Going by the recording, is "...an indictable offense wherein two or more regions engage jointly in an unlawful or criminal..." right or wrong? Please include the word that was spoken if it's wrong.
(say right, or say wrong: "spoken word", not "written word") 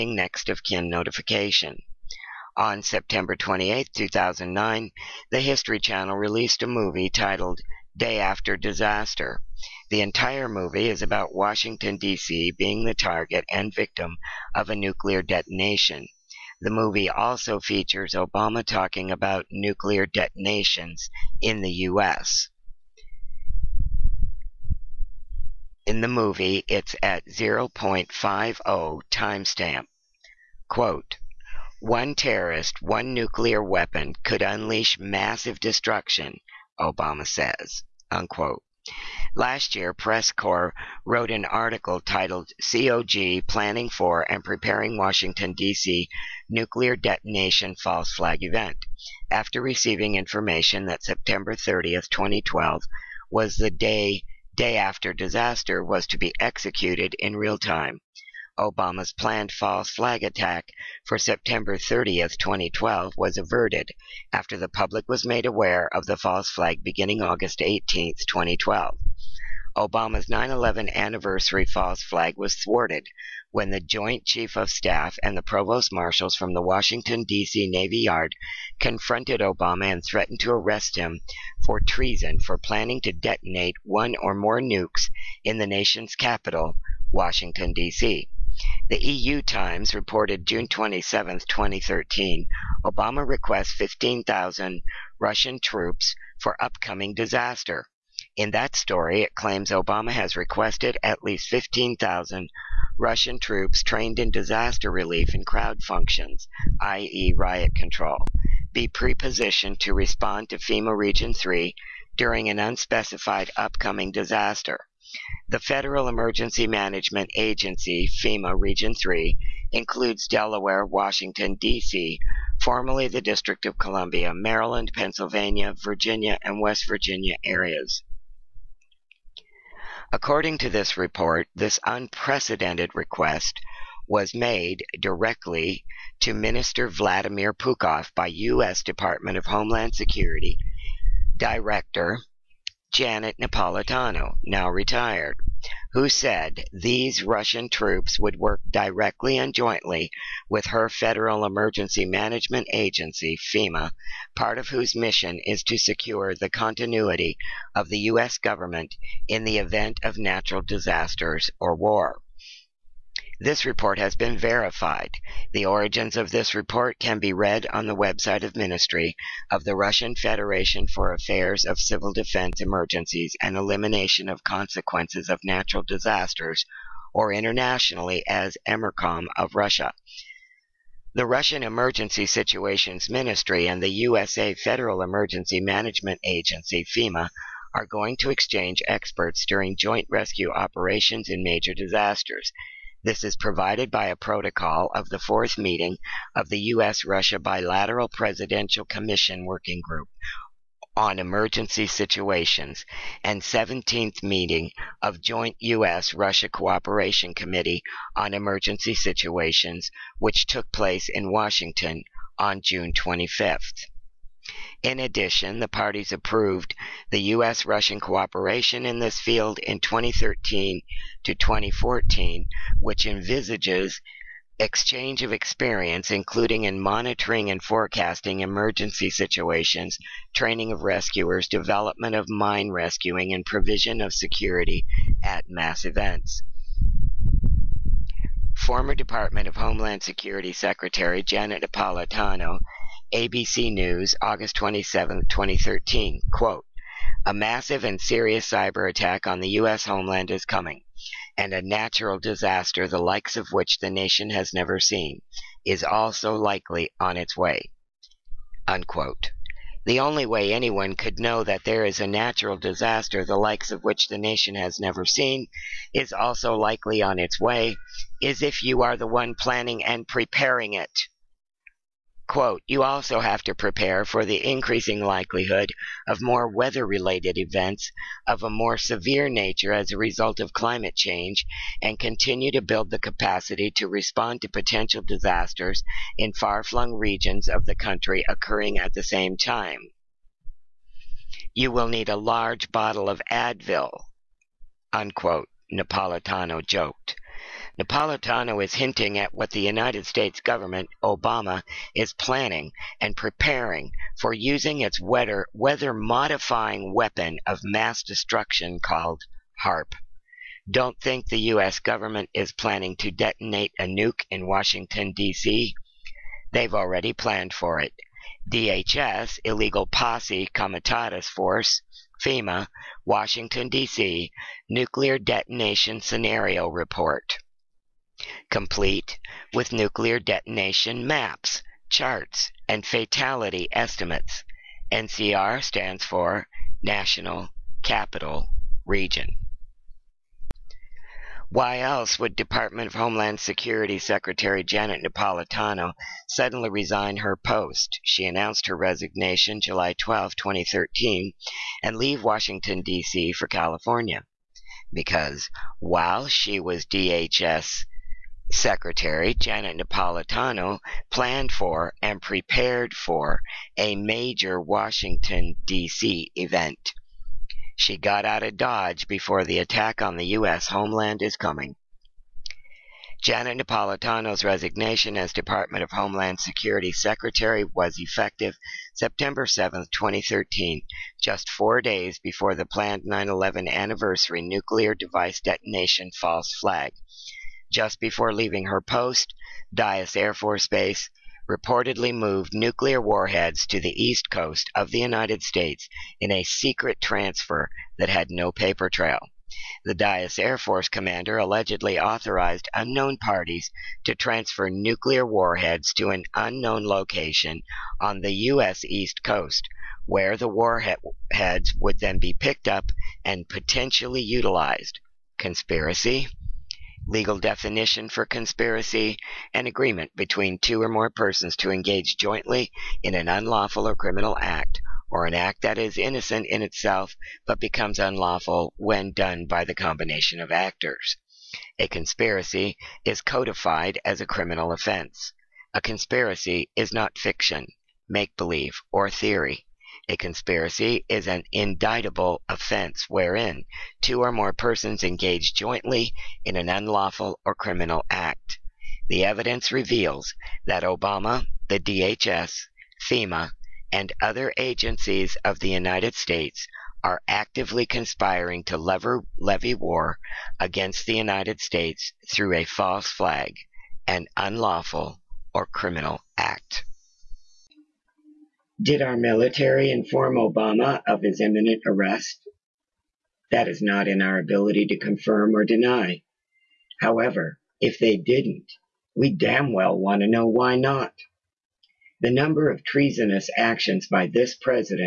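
wrong: "persons", not "regions".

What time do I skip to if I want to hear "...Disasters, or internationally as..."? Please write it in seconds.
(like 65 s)
175 s.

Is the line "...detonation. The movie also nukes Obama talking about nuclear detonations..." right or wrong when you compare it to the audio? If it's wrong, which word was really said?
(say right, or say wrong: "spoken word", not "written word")
wrong: "features", not "nukes".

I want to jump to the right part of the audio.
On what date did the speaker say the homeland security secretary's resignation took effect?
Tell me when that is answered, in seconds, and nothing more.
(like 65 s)
378 s.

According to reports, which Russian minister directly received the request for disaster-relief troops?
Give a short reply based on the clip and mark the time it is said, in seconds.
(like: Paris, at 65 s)
Vladimir Puchkov, at 136 s.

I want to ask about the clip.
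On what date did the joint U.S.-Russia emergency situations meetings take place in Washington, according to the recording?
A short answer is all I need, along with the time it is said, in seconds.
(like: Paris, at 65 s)
June 25, at 212 s.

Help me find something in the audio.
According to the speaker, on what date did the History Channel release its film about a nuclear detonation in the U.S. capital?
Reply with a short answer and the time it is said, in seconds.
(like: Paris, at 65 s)
September 28, 2009, at 2 s.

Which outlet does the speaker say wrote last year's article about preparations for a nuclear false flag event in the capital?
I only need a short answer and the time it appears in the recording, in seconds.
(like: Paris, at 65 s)
PressCore, at 39 s.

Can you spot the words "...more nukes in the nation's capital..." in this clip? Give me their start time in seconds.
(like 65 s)
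84 s.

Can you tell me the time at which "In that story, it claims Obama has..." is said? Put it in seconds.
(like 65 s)
98 s.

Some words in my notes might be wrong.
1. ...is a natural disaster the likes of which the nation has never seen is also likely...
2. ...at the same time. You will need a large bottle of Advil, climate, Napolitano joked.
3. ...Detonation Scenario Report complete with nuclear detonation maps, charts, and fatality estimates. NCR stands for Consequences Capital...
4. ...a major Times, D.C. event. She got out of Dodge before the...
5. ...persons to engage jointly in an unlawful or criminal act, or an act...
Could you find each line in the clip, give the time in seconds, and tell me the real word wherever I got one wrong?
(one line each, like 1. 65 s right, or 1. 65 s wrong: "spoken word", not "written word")
1. 261 s right
2. 288 s wrong: "unquote", not "climate"
3. 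325 s wrong: "National", not "Consequences"
4. 363 s wrong: "Washington", not "Times"
5. 421 s right.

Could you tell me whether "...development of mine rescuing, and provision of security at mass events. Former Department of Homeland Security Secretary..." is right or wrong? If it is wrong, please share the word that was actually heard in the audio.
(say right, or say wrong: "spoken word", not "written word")
right.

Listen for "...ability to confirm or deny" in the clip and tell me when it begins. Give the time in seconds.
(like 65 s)
474 s.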